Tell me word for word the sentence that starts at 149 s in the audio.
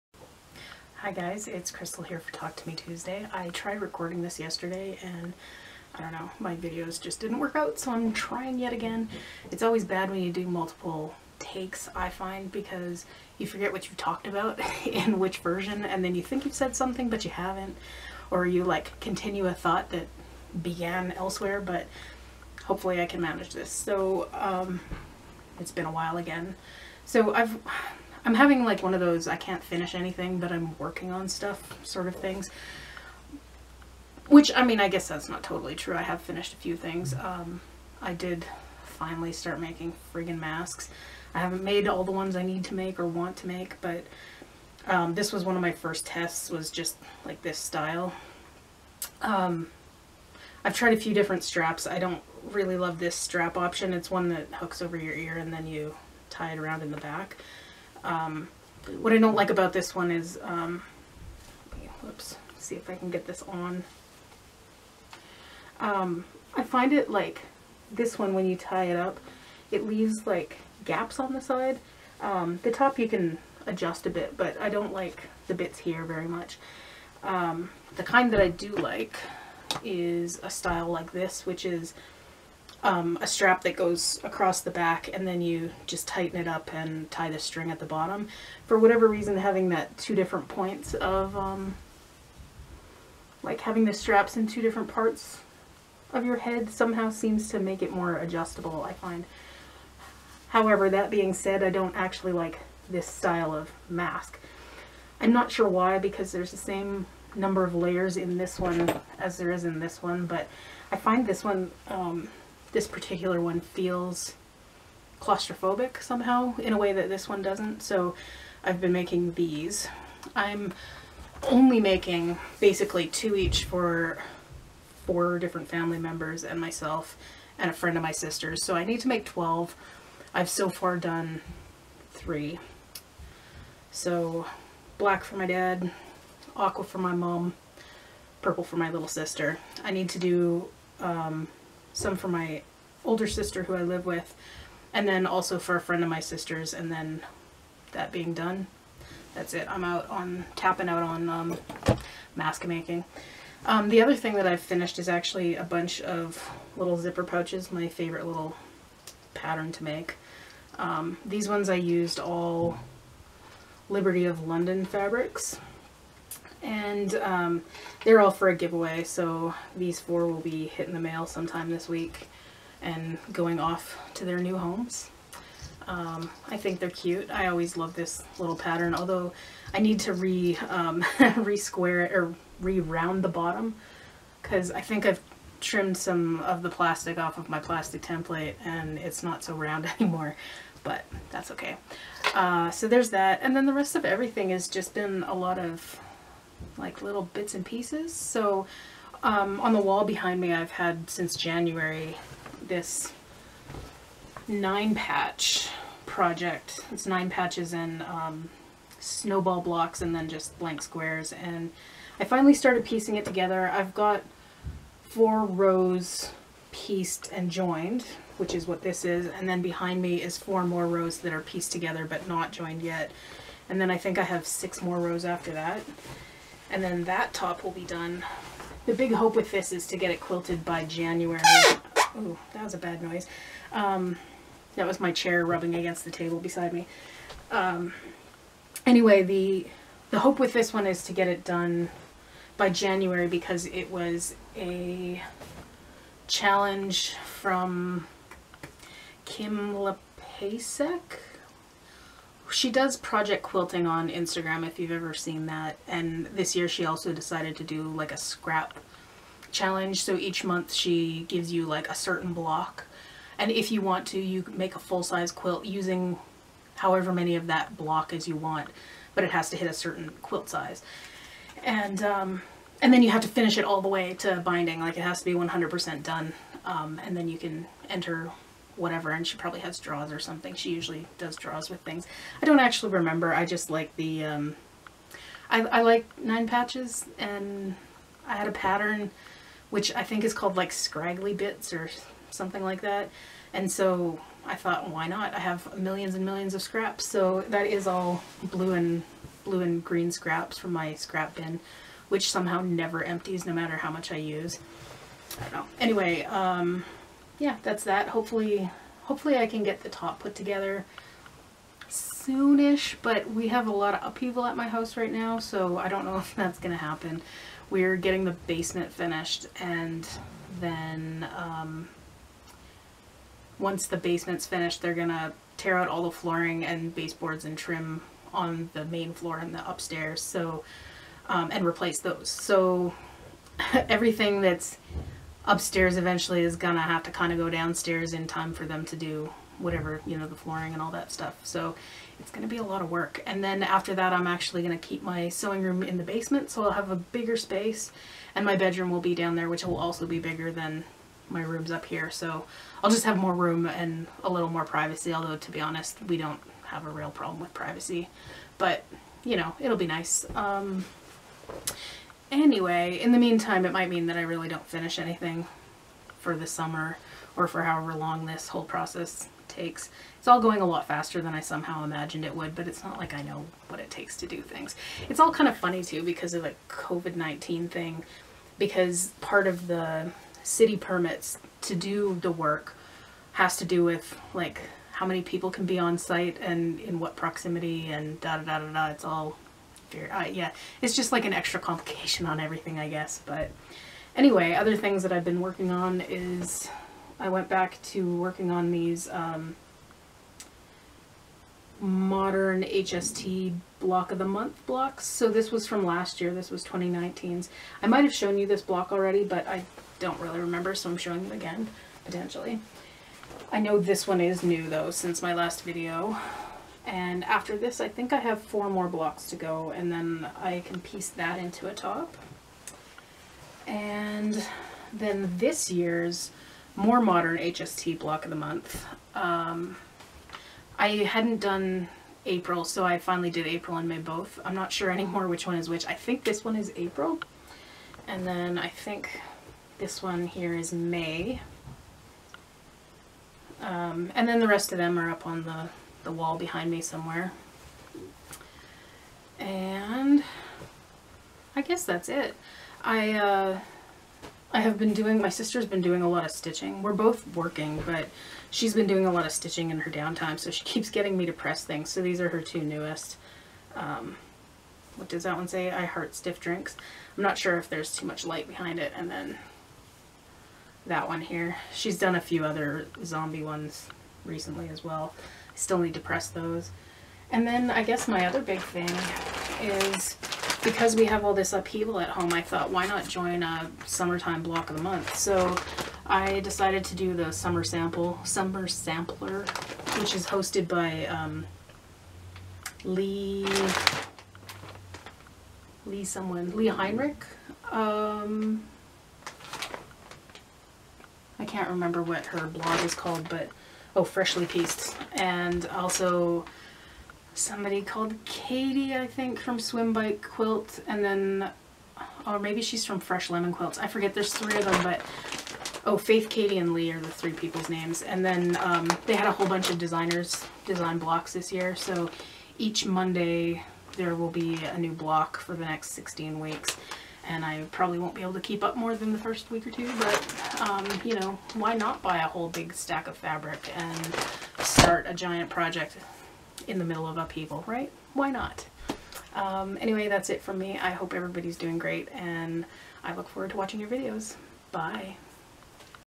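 I'm out on tapping out on um, mask making.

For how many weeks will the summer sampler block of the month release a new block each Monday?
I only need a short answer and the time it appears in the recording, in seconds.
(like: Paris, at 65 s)
16, at 525 s.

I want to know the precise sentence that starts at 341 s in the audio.
So it's going to be a lot of work.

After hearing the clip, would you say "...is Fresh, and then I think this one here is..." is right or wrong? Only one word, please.
wrong.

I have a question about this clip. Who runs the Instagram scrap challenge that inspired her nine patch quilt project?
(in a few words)
Kim Lapacek.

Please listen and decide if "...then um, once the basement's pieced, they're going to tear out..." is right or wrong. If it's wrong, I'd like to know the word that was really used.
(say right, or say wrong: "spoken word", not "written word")
wrong: "finished", not "pieced".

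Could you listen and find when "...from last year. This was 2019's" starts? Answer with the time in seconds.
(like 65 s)
405 s.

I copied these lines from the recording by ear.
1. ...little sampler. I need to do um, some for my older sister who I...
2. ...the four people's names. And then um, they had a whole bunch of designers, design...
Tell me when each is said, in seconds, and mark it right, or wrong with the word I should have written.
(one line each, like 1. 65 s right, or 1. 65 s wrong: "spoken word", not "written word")
1. 138 s wrong: "sister", not "sampler"
2. 516 s wrong: "three", not "four".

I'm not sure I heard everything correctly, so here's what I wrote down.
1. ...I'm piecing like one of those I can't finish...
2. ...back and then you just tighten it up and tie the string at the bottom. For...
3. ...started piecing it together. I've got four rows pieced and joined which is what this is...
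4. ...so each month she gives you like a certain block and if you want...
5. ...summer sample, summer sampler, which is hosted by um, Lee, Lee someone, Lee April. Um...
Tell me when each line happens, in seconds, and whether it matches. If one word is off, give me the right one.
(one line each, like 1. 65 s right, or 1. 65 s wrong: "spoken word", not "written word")
1. 28 s wrong: "having", not "piecing"
2. 84 s right
3. 212 s right
4. 260 s right
5. 487 s wrong: "Heinrich", not "April".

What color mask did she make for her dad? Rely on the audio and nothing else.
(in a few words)
Black.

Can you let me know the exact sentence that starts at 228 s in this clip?
The big hope with this is to get it quilted by January.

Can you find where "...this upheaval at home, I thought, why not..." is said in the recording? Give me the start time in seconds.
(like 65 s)
481 s.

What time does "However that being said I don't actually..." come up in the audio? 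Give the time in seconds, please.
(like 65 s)
100 s.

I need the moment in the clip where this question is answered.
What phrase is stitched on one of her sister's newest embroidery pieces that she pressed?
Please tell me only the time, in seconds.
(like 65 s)
465 s.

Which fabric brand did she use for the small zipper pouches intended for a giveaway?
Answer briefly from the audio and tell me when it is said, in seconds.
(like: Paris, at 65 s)
Liberty of London, at 163 s.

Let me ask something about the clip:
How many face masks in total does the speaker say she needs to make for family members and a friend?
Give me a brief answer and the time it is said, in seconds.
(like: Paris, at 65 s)
12, at 129 s.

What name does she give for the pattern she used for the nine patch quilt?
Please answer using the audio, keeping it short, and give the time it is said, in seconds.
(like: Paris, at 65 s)
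Scraggly bits, at 290 s.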